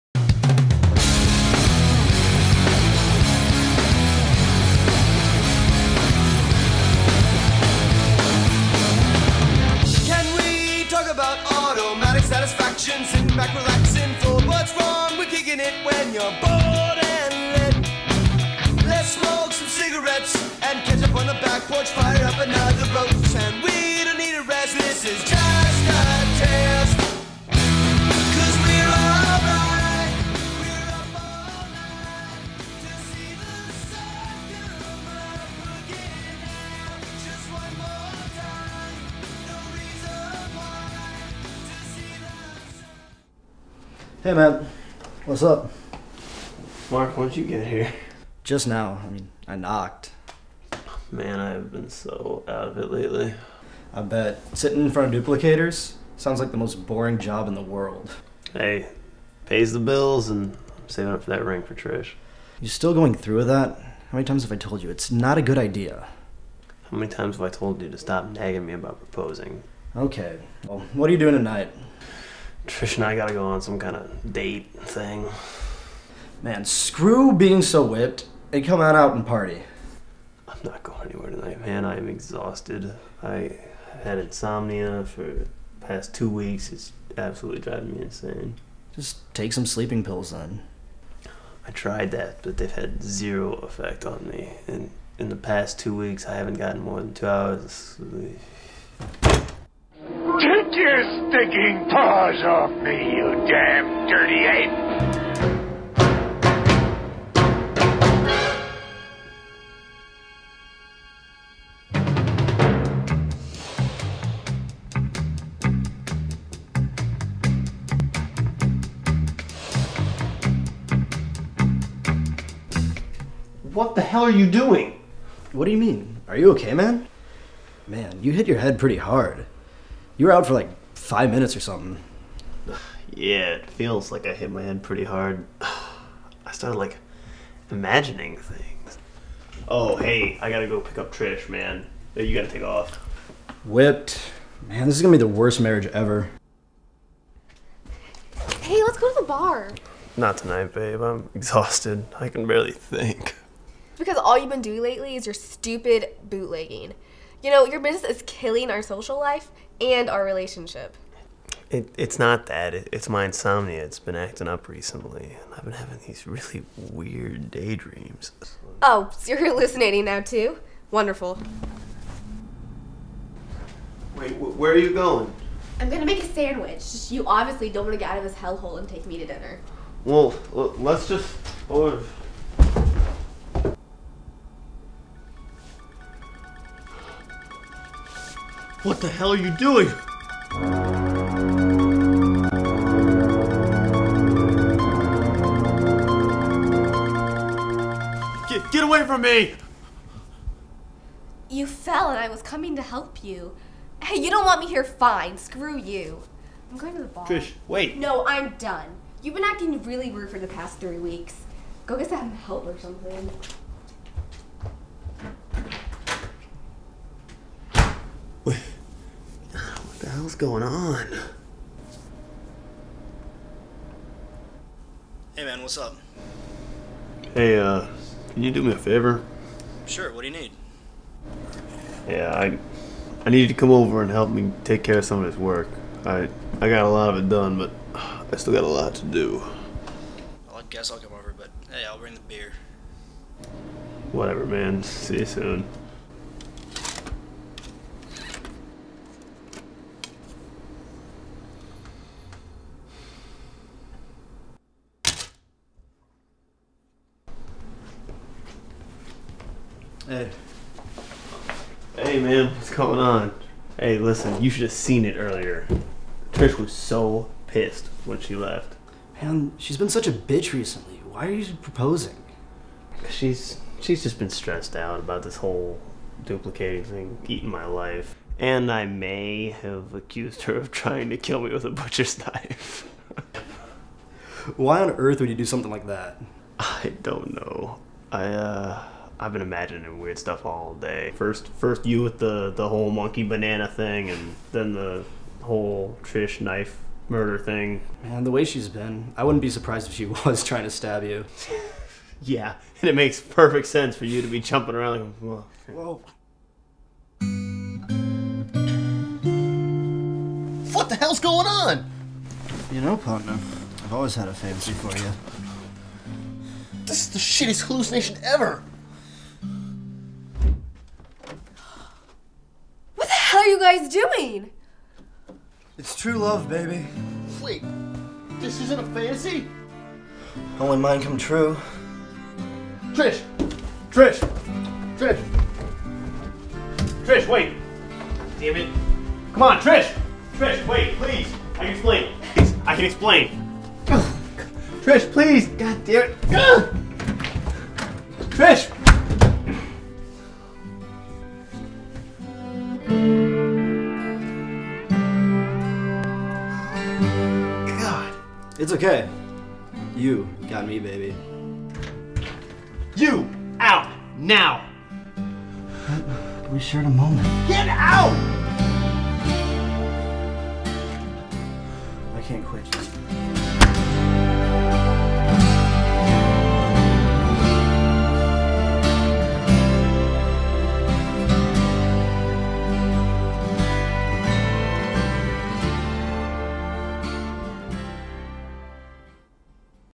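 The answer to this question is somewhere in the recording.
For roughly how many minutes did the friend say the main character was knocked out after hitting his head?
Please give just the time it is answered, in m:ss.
2:10.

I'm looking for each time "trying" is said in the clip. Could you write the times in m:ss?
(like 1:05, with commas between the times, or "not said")
4:40, 5:00.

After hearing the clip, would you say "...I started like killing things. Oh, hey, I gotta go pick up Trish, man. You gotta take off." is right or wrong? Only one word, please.
wrong.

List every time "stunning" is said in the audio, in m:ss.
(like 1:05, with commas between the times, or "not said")
not said.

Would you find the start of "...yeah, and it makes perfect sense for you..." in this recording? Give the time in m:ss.
5:02.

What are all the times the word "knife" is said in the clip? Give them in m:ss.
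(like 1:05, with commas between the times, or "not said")
4:42, 4:56.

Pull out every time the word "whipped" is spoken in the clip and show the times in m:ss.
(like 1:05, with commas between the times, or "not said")
1:17, 2:23.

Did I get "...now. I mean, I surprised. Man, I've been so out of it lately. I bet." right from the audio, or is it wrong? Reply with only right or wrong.
wrong.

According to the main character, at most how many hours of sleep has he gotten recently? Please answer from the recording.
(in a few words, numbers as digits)
2 hours.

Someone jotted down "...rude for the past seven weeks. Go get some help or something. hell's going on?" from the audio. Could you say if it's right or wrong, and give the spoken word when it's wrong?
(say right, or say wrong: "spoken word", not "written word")
wrong: "three", not "seven".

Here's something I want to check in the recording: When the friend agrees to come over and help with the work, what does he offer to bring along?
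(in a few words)
Beer.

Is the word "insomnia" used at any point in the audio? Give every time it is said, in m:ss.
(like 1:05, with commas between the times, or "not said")
1:24, 2:43.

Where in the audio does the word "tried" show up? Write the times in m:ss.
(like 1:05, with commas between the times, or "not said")
1:31.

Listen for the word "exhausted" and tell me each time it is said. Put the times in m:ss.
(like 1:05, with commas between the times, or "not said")
1:22, 2:31.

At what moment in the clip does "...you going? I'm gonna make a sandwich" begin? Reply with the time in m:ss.
2:54.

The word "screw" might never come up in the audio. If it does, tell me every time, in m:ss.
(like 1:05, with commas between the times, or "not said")
1:16, 3:25.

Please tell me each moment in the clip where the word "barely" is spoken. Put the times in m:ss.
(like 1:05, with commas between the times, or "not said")
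2:32.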